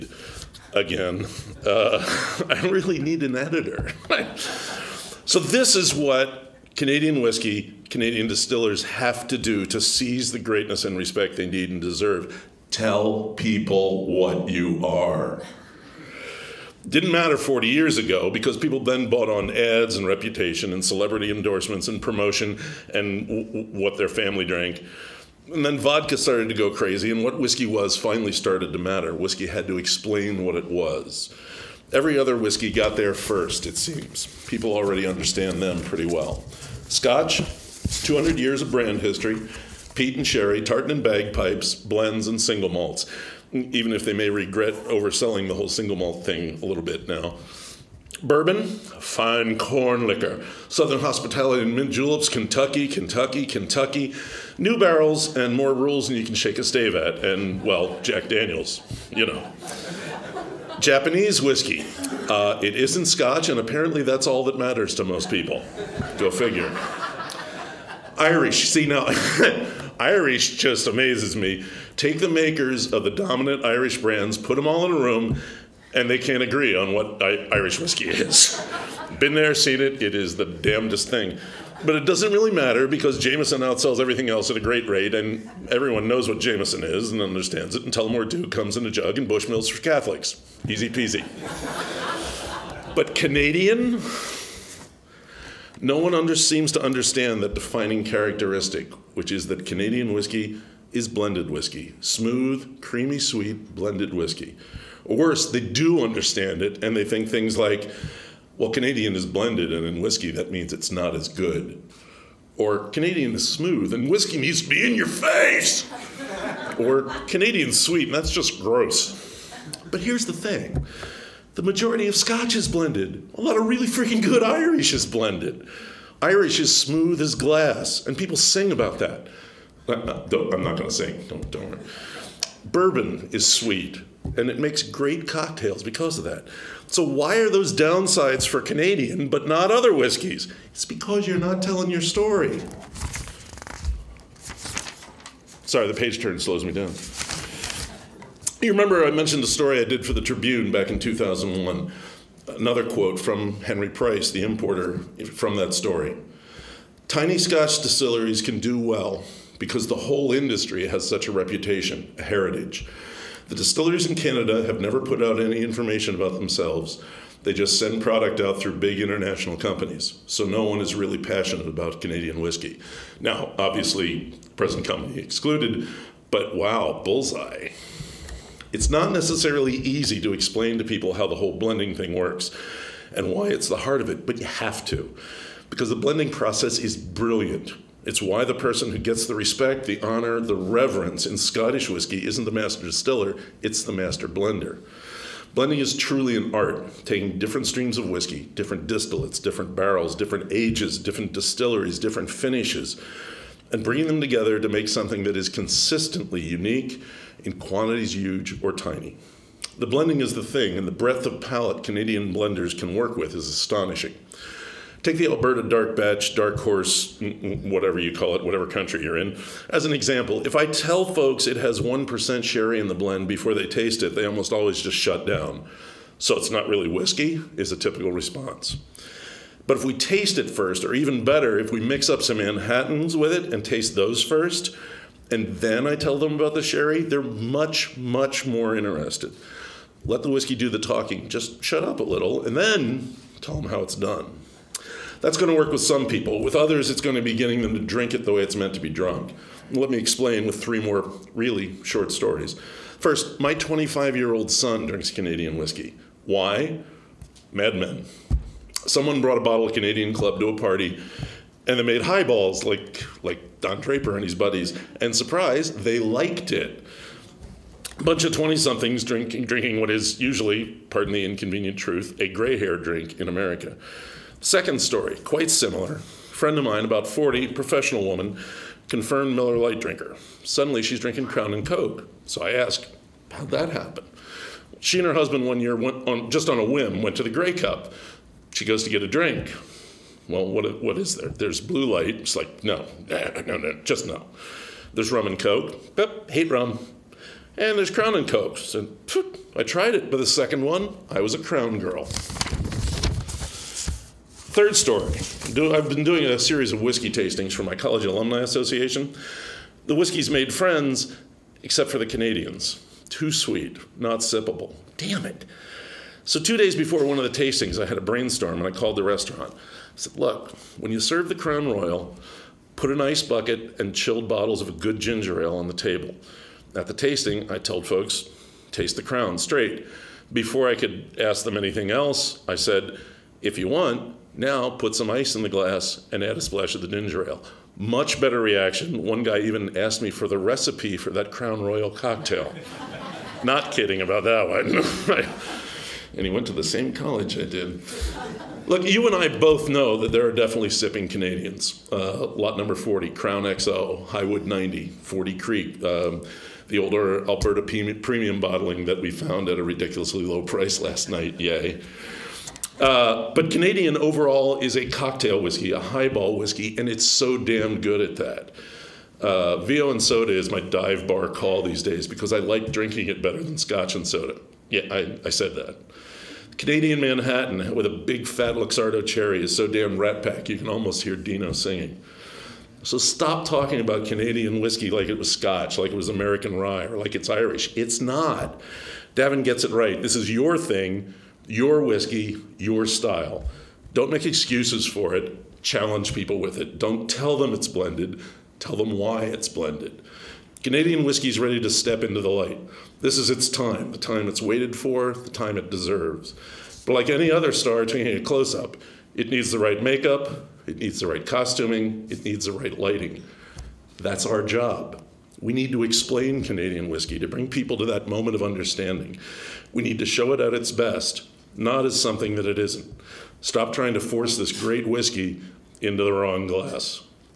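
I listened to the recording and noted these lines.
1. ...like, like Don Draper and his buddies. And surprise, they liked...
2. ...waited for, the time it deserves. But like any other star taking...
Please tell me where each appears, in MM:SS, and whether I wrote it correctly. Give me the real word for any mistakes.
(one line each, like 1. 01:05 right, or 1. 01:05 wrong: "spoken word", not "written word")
1. 04:22 right
2. 06:44 right.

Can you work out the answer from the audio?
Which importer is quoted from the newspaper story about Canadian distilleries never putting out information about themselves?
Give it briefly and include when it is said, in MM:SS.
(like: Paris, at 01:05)
Henry Price, at 02:33.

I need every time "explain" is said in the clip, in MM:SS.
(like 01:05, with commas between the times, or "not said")
00:29, 03:00, 04:09, 06:55.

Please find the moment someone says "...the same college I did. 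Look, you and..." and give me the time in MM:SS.
05:46.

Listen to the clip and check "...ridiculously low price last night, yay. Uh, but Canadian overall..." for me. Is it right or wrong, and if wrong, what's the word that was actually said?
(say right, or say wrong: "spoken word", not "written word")
right.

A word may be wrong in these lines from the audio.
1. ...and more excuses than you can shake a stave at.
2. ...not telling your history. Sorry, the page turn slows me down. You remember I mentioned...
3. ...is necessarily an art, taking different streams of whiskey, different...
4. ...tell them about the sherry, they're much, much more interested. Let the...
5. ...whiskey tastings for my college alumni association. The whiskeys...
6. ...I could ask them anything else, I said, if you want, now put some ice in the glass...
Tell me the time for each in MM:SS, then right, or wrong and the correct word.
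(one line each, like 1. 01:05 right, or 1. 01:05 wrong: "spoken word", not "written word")
1. 00:55 wrong: "rules", not "excuses"
2. 02:21 wrong: "story", not "history"
3. 03:15 wrong: "truly", not "necessarily"
4. 03:55 right
5. 05:06 right
6. 05:30 right.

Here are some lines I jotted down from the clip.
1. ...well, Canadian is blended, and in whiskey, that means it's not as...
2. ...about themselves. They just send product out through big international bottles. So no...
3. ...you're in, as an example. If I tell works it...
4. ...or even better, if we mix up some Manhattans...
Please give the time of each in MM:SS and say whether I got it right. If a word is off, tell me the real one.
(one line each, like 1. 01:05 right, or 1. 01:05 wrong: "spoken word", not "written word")
1. 01:48 right
2. 02:46 wrong: "companies", not "bottles"
3. 03:39 wrong: "folks", not "works"
4. 03:50 right.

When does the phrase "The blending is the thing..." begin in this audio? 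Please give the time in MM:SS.
03:29.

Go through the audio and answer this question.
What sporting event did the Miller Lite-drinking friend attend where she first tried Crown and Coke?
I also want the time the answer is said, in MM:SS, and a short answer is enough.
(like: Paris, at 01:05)
Grey Cup, at 04:47.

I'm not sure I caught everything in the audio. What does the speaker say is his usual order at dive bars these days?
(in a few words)
VO and soda.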